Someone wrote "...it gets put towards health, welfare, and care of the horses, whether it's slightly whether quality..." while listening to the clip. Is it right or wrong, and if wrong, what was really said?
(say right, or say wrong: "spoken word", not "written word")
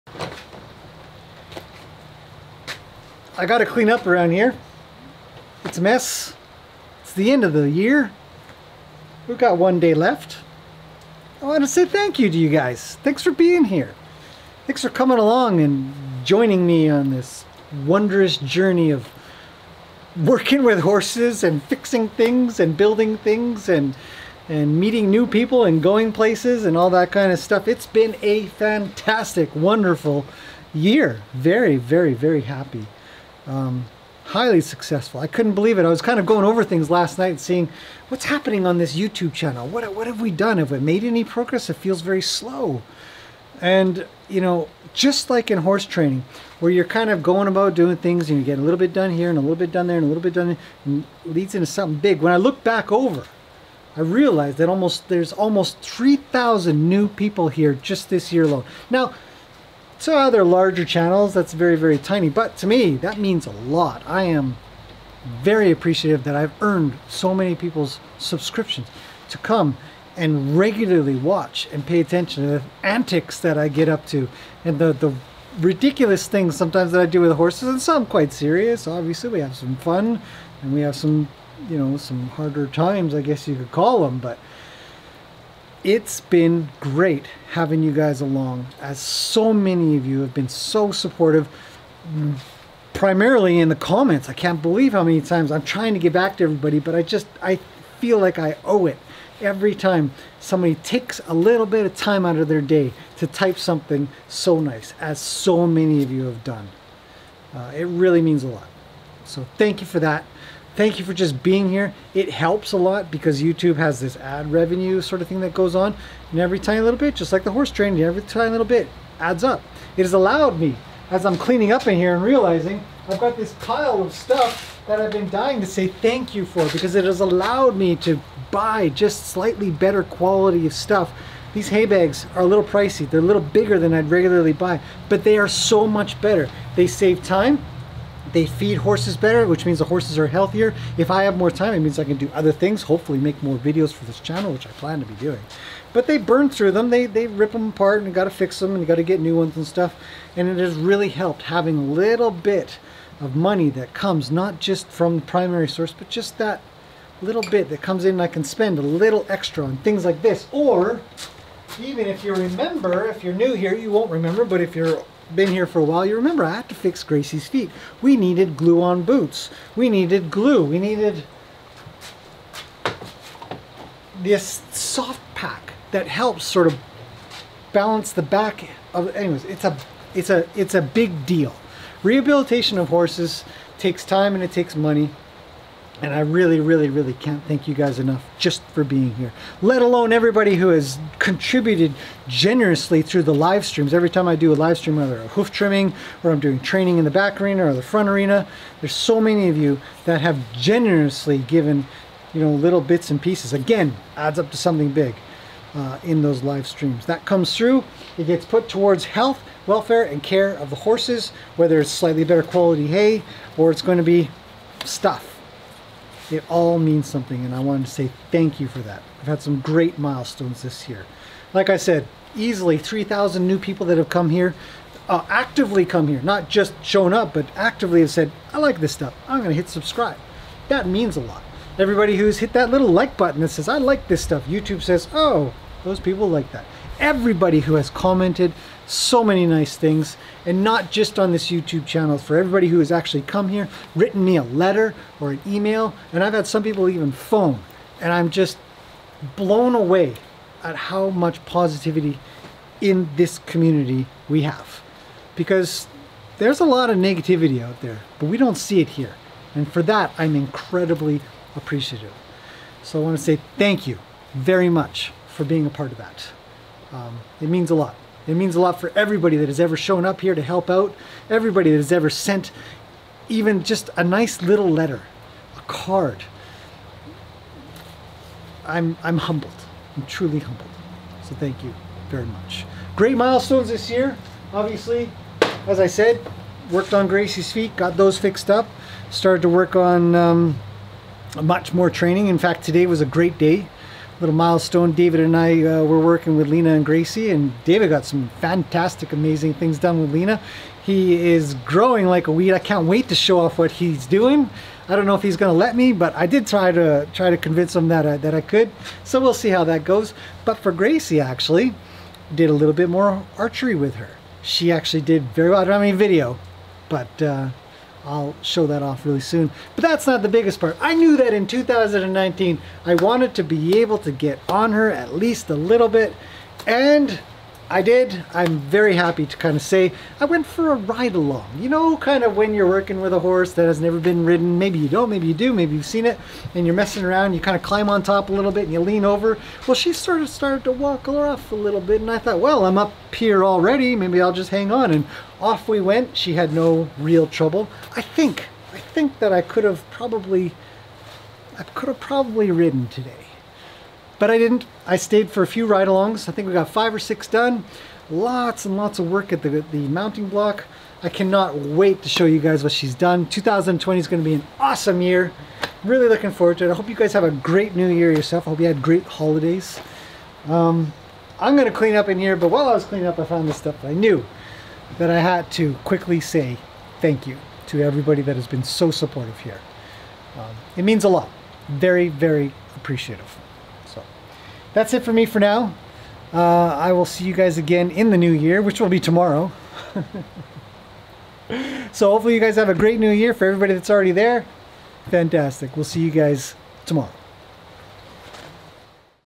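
wrong: "better", not "whether".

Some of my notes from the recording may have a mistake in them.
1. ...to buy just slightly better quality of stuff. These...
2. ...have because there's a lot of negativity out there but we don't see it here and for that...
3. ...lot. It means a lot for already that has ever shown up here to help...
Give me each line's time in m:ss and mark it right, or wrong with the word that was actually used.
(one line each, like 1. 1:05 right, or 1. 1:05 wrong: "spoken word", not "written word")
1. 2:07 right
2. 4:14 right
3. 4:27 wrong: "everybody", not "already".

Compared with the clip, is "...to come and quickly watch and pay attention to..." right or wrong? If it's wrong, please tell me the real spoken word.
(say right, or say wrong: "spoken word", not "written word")
wrong: "regularly", not "quickly".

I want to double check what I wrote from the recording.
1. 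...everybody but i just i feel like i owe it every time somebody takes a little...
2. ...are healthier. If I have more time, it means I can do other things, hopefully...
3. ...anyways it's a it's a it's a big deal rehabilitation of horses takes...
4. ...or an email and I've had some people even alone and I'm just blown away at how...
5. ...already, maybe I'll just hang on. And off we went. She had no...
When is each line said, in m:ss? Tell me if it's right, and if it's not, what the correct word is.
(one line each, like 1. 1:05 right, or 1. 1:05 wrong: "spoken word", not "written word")
1. 1:36 right
2. 2:20 right
3. 2:59 right
4. 4:05 wrong: "phone", not "alone"
5. 5:43 right.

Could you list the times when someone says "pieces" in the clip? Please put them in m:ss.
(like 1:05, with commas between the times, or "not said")
3:23.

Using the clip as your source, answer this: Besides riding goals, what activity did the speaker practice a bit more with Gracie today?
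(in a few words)
archery.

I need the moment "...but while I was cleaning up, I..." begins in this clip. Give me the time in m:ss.
6:12.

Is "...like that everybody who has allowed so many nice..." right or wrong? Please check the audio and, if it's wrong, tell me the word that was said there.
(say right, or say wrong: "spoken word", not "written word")
wrong: "commented", not "allowed".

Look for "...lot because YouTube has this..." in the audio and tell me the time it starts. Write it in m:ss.
1:52.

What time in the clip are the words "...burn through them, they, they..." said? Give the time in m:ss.
2:26.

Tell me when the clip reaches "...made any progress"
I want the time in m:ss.
0:40.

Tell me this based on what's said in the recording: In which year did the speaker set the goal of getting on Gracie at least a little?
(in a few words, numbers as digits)
2019.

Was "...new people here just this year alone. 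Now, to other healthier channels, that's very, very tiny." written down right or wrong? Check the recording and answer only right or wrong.
wrong.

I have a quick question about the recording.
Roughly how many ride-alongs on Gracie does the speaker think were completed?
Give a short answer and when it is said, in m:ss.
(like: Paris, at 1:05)
5 or 6, at 5:56.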